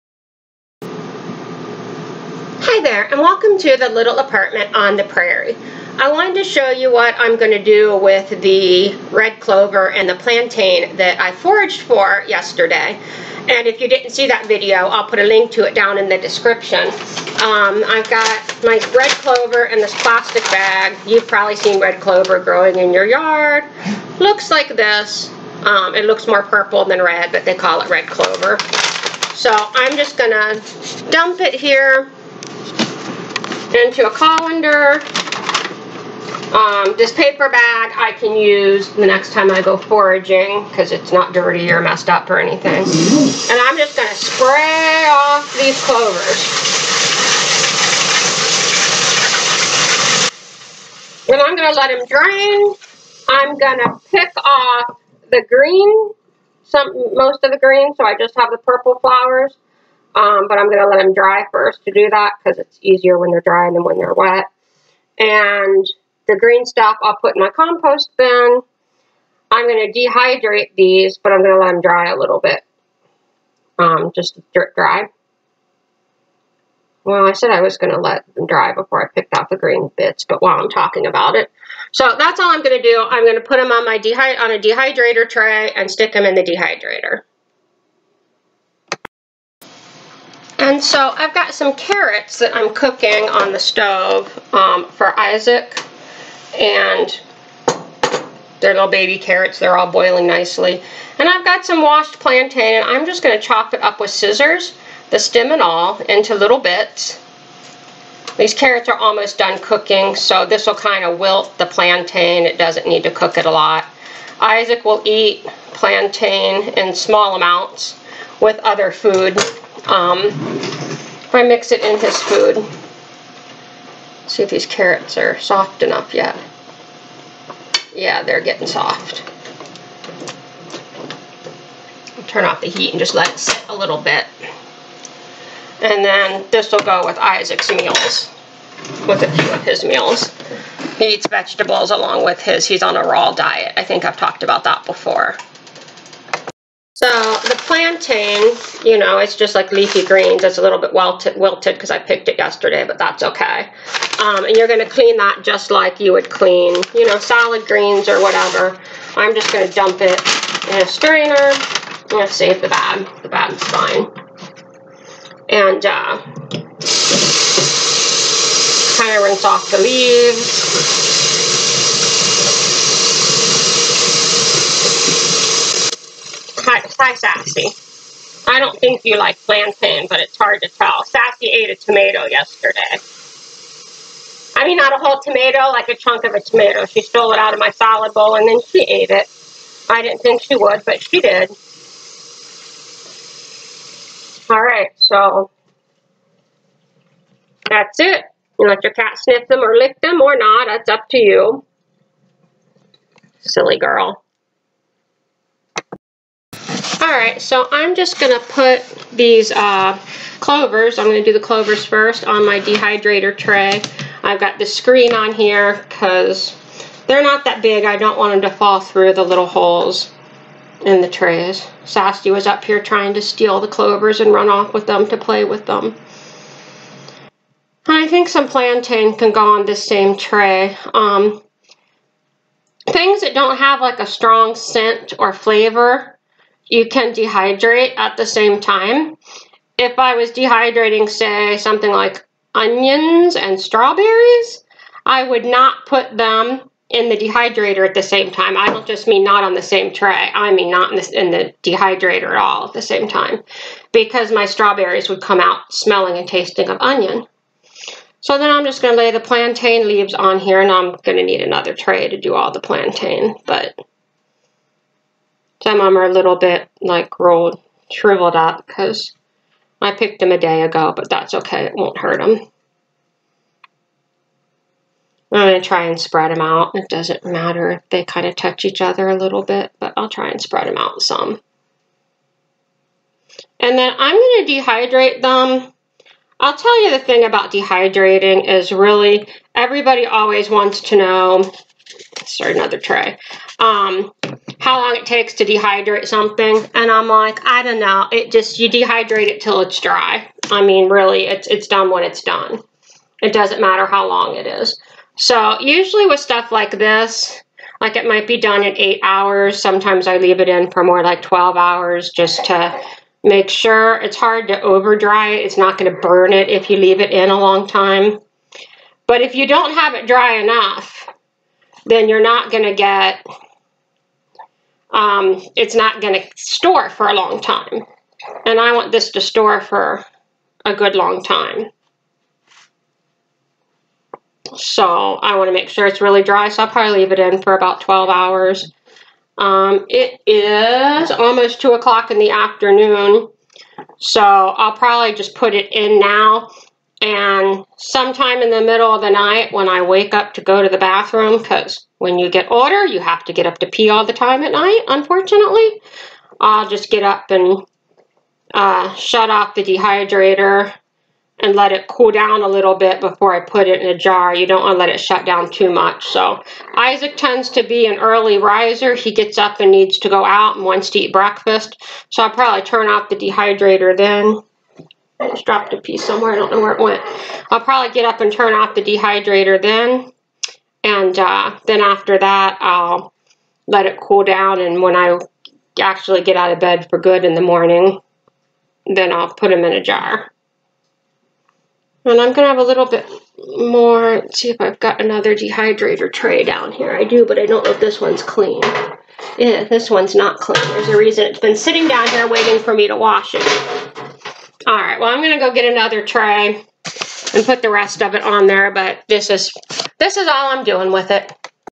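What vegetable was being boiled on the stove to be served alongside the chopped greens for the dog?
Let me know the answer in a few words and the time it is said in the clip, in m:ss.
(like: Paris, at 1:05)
baby carrots, at 1:38.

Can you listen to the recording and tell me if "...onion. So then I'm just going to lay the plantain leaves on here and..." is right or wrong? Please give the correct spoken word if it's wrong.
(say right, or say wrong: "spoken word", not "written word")
right.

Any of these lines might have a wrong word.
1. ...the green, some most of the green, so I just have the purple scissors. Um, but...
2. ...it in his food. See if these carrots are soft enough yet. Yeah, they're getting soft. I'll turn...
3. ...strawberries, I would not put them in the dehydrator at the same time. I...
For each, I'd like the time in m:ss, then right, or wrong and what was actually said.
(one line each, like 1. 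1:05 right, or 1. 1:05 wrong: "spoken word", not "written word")
1. 0:55 wrong: "flowers", not "scissors"
2. 2:01 right
3. 4:03 right.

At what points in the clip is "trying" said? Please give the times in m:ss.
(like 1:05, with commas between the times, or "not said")
3:42.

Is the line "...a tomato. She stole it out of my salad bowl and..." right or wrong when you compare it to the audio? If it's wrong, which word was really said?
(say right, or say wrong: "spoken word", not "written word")
right.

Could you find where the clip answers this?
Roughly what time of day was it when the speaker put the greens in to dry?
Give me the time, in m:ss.
5:41.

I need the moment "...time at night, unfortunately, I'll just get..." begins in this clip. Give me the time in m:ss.
5:54.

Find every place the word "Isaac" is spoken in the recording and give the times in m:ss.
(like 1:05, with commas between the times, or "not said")
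1:35, 1:54, 2:17, 6:06.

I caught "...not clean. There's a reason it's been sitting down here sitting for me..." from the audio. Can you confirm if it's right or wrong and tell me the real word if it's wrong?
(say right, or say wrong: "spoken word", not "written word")
wrong: "waiting", not "sitting".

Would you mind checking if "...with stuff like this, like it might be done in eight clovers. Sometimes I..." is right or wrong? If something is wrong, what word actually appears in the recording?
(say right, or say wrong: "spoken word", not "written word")
wrong: "hours", not "clovers".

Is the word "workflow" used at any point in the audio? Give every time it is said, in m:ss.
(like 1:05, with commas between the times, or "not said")
not said.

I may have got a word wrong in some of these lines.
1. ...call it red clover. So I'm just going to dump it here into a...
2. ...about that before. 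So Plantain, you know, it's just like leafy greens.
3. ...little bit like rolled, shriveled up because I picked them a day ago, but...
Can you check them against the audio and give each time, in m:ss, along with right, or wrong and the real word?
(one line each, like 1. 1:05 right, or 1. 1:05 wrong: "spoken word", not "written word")
1. 0:27 right
2. 2:24 right
3. 4:26 right.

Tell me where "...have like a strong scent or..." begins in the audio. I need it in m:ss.
3:53.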